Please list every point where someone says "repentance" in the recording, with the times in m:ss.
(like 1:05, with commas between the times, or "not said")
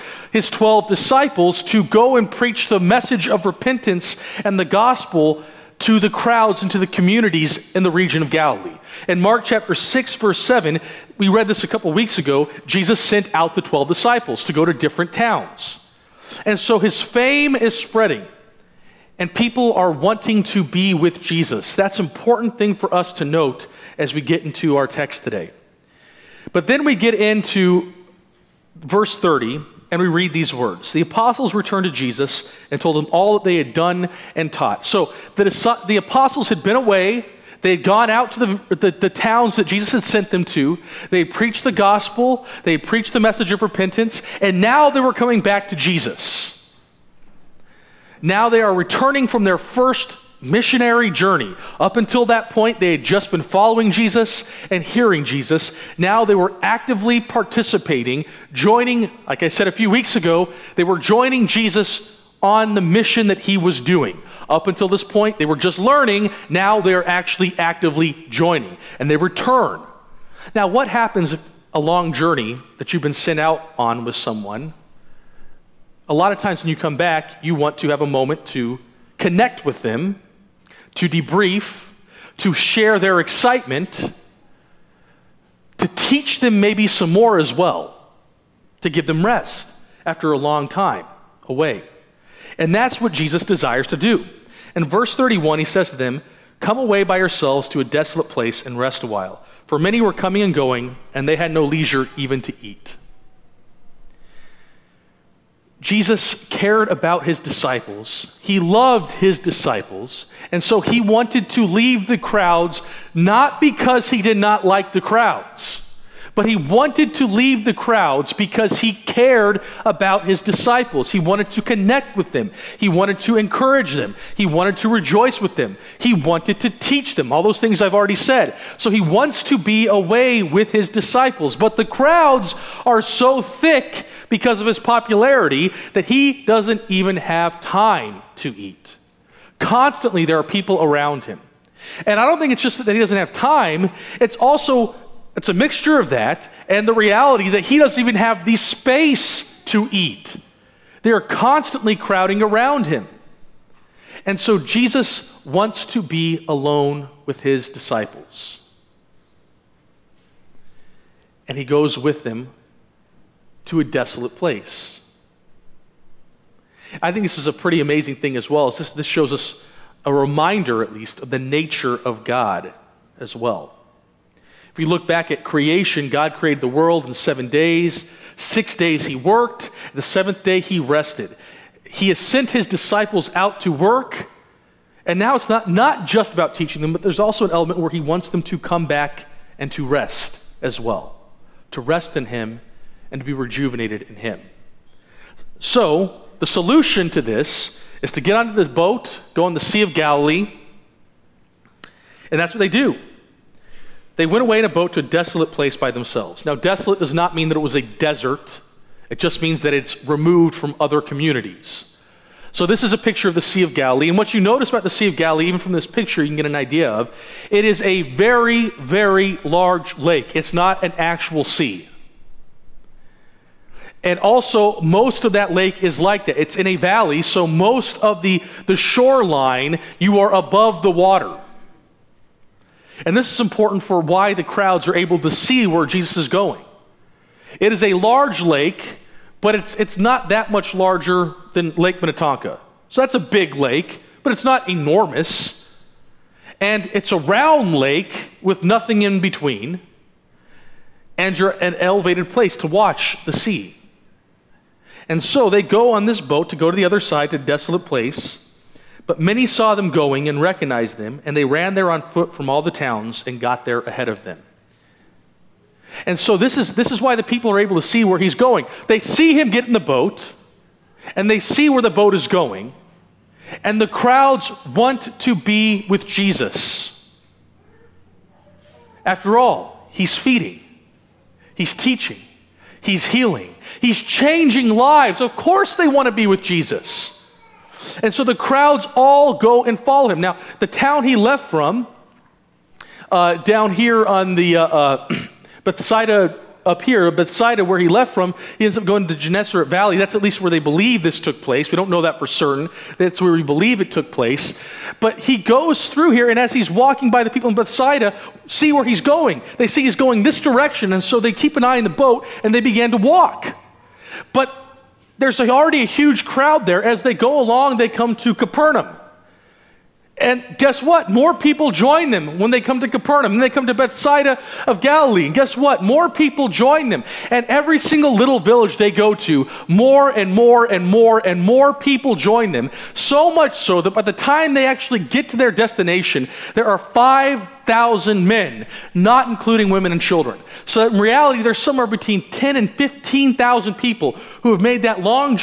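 0:03, 0:43.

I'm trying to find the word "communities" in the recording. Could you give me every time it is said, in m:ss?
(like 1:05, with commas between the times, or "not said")
0:06, 3:31.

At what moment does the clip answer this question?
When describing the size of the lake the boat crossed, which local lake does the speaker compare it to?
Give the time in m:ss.
4:01.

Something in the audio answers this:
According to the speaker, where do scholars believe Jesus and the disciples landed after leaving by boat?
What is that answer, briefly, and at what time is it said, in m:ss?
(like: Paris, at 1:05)
Gennesaret Valley, at 4:59.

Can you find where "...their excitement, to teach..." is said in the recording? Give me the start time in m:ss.
1:22.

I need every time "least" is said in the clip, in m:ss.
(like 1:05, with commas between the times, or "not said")
2:50, 5:00.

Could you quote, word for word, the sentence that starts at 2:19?
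Constantly, there are people around him.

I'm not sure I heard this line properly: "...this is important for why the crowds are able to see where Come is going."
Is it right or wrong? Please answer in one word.
wrong.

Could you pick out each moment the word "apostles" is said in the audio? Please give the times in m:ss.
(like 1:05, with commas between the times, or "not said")
0:31, 0:35.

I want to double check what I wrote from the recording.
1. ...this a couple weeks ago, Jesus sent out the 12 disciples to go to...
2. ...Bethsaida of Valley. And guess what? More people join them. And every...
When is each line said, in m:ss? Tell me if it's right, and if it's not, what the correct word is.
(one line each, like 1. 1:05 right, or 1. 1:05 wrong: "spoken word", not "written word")
1. 0:11 right
2. 5:23 wrong: "Galilee", not "Valley".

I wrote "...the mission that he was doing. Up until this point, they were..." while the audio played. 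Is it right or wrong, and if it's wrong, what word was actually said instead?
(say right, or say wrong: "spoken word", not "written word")
right.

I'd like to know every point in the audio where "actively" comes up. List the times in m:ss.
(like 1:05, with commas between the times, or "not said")
0:56, 1:07.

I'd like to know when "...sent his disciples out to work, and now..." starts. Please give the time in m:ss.
3:02.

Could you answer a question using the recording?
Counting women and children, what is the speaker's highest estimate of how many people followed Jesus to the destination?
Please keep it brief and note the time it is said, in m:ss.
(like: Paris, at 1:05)
15,000, at 5:42.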